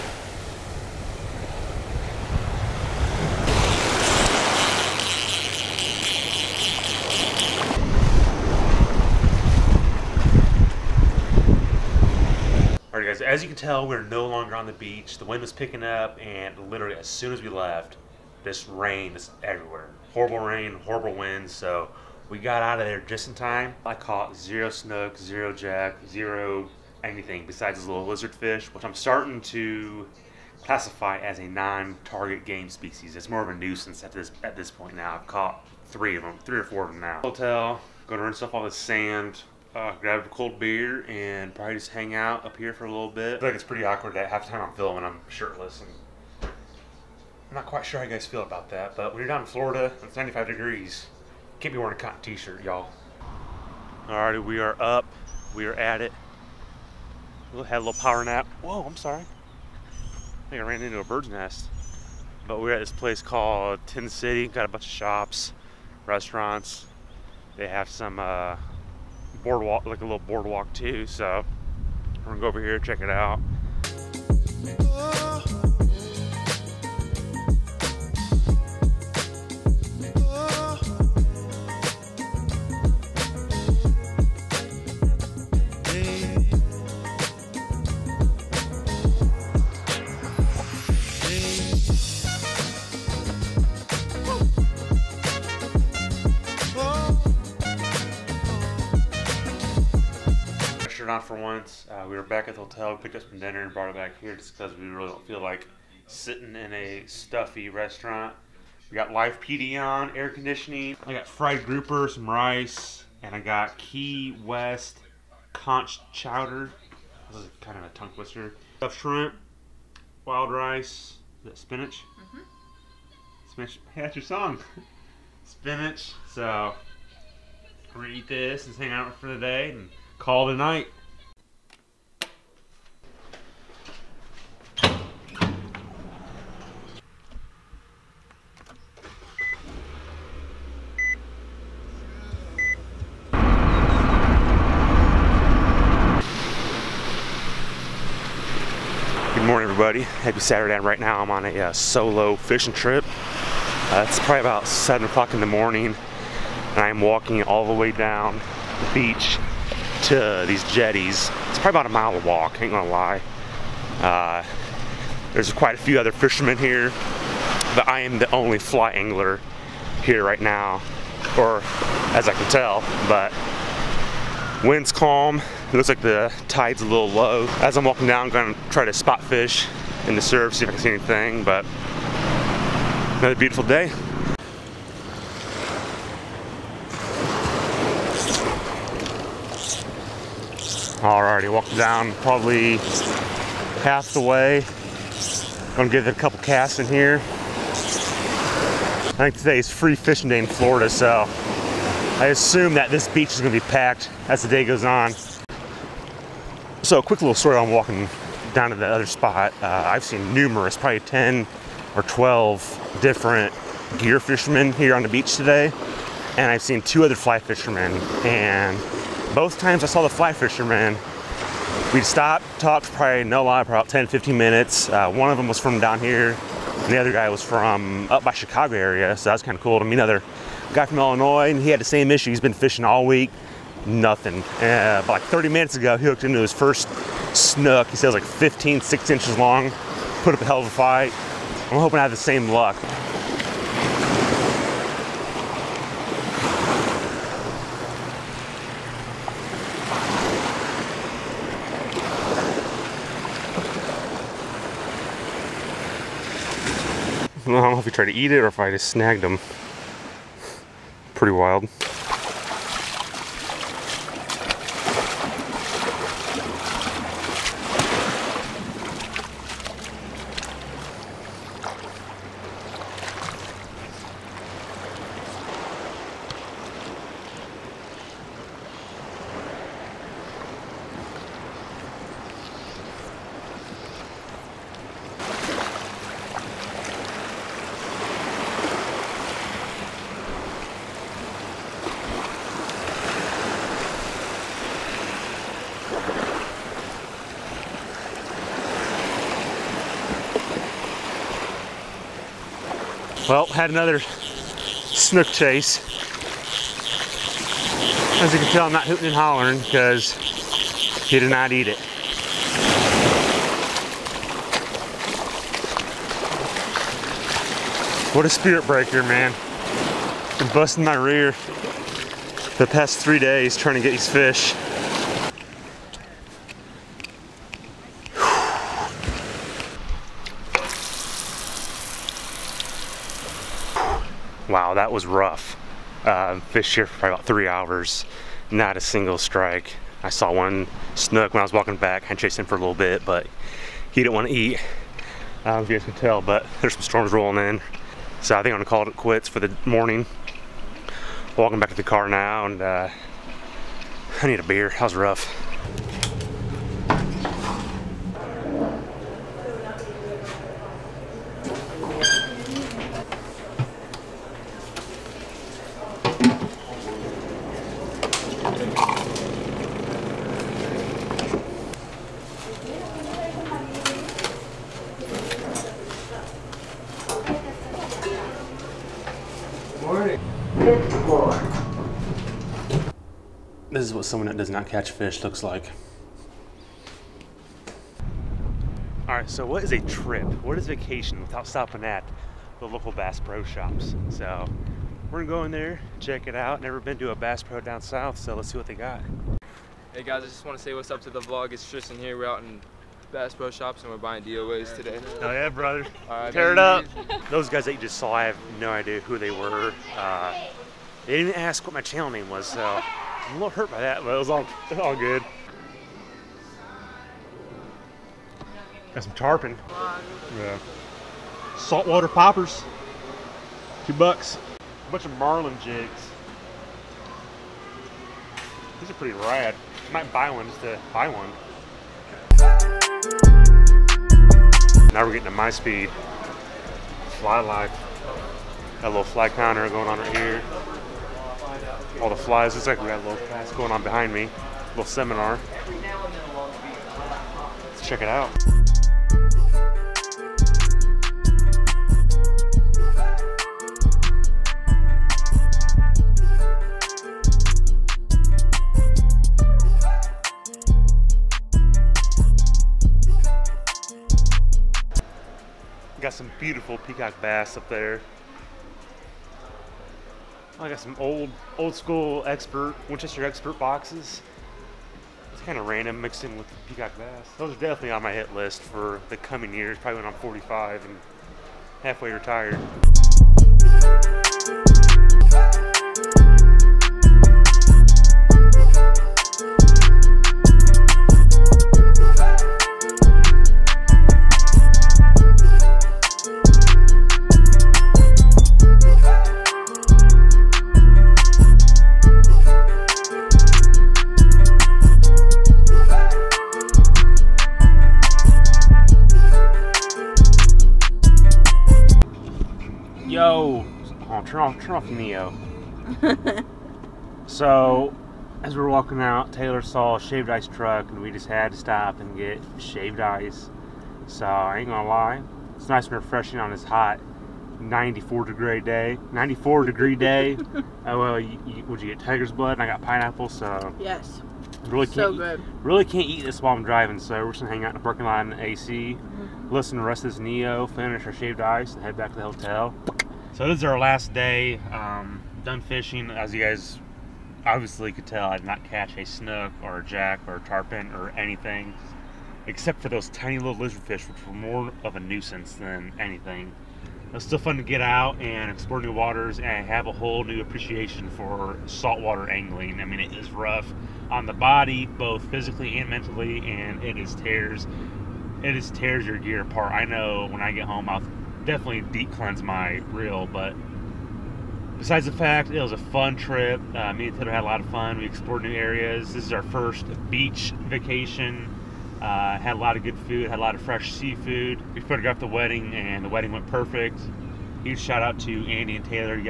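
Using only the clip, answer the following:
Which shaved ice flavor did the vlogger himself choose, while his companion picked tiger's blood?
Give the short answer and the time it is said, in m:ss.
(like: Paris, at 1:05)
Pineapple, at 8:52.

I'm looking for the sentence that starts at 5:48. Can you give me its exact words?
So I think I'm gonna call it quits for the morning.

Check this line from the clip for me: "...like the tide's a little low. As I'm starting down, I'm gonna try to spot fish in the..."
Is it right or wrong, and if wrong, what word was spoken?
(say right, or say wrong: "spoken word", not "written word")
wrong: "walking", not "starting".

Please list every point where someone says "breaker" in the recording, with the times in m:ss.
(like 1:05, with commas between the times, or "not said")
5:18.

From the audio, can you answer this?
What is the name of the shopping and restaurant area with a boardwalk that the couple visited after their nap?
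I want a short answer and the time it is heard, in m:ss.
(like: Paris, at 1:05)
Tin City, at 1:03.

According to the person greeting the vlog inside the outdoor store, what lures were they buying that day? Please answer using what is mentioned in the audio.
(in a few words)
DOAs.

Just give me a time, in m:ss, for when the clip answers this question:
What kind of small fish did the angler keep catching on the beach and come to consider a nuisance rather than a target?
0:28.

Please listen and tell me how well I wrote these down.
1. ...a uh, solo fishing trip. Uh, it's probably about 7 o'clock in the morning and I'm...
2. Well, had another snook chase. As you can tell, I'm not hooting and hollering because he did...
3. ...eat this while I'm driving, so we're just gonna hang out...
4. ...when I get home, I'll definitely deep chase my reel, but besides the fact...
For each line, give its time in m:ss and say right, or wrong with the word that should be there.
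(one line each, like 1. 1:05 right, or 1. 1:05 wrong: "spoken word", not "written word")
1. 2:31 right
2. 5:03 right
3. 8:56 right
4. 9:30 wrong: "cleanse", not "chase".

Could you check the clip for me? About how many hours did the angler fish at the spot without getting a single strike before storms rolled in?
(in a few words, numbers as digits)
3.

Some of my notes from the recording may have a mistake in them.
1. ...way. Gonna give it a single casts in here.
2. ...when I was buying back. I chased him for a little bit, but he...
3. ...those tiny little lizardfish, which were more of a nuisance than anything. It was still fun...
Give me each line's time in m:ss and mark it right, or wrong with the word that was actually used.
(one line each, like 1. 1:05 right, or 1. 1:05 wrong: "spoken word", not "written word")
1. 3:14 wrong: "couple", not "single"
2. 5:41 wrong: "walking", not "buying"
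3. 9:12 right.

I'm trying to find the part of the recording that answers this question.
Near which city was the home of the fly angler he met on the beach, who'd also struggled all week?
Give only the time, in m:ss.
3:48.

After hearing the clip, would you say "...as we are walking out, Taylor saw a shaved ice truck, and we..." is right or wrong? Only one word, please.
right.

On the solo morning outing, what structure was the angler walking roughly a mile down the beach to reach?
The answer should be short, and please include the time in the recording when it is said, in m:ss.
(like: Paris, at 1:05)
Jetties, at 2:40.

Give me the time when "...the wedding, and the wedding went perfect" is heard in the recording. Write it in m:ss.
9:45.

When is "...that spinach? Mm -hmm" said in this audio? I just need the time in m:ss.
2:01.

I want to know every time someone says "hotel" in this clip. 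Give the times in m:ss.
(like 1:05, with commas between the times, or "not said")
0:37, 1:42, 9:02.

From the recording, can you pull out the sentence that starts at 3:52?
He's been fishing all week, nothing.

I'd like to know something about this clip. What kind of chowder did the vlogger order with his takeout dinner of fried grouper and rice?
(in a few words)
Key West conch chowder.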